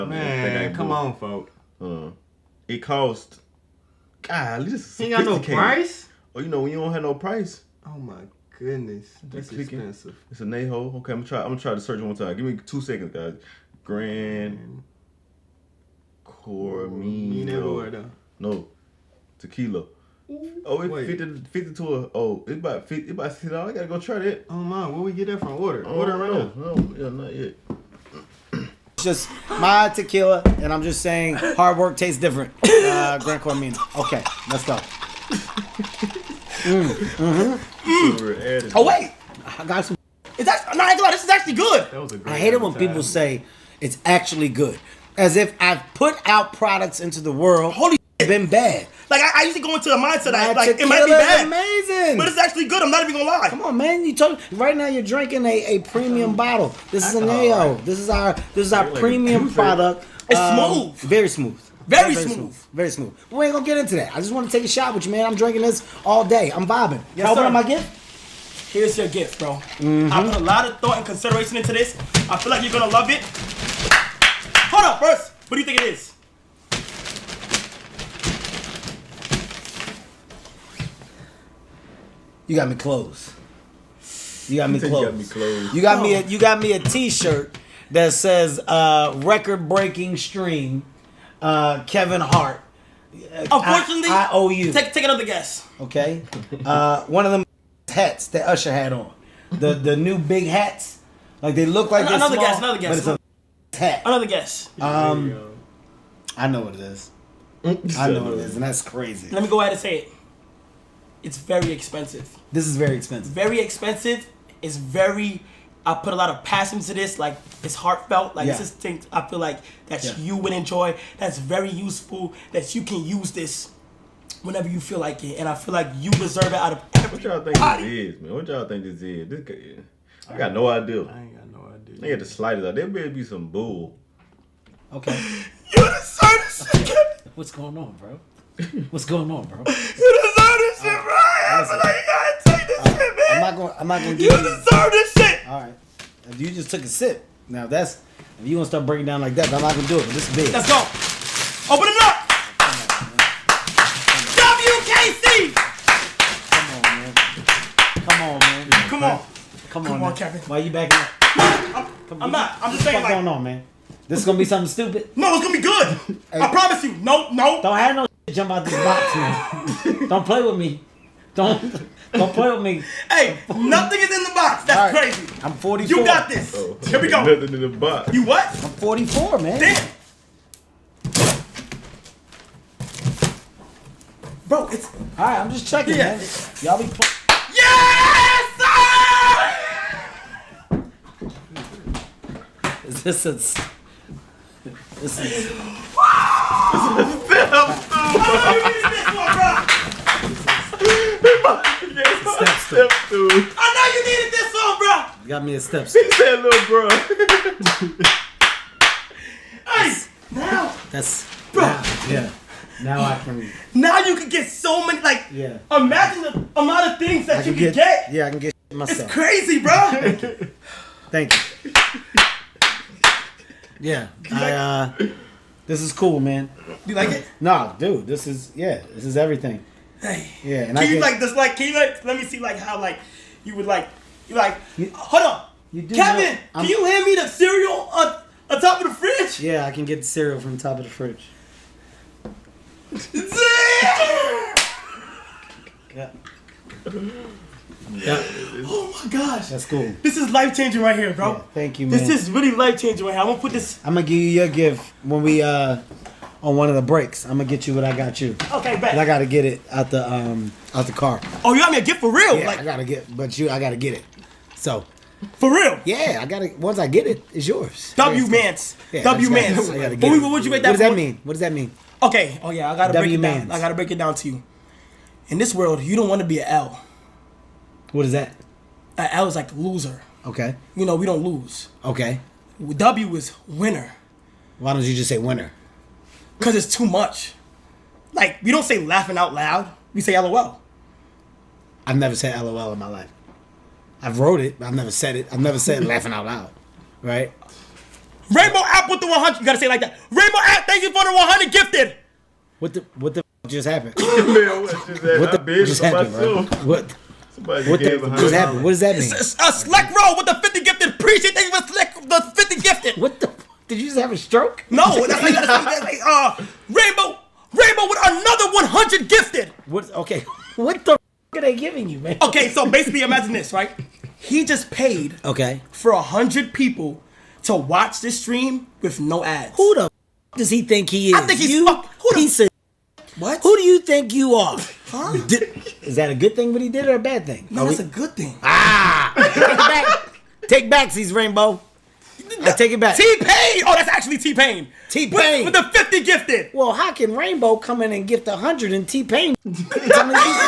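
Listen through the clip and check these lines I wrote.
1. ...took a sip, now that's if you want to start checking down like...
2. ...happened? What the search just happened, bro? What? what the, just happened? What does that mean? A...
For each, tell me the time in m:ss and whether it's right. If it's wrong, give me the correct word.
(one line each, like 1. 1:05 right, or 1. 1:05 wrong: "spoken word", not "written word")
1. 2:26 wrong: "breaking", not "checking"
2. 5:04 wrong: "bitch", not "search".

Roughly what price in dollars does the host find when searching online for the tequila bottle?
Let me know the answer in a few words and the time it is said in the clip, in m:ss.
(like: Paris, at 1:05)
60 dollars, at 0:23.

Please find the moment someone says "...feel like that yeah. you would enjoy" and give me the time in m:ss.
1:59.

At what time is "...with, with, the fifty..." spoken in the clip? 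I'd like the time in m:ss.
5:45.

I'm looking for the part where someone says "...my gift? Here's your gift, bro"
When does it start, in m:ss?
1:07.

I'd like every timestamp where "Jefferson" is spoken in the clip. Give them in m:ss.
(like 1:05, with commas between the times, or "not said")
not said.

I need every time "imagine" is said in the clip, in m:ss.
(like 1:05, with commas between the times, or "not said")
3:35, 5:22.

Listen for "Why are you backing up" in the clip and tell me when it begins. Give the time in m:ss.
2:40.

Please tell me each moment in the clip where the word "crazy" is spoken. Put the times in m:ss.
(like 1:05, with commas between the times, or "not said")
1:48, 2:55, 3:39.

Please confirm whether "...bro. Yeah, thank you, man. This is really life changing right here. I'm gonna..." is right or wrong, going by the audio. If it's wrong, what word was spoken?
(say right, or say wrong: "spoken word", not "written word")
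right.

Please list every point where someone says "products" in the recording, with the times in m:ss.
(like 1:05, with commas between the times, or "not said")
0:46, 0:59.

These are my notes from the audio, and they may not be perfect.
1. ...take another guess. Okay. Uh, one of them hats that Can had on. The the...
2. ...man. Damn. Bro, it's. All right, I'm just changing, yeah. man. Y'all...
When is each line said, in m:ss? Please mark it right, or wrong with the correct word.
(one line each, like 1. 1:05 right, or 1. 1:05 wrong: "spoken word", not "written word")
1. 1:34 wrong: "Usher", not "Can"
2. 2:59 wrong: "checking", not "changing".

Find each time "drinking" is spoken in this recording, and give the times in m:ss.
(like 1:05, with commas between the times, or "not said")
0:55, 1:05.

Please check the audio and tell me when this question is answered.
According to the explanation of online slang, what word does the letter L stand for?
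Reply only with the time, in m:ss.
4:39.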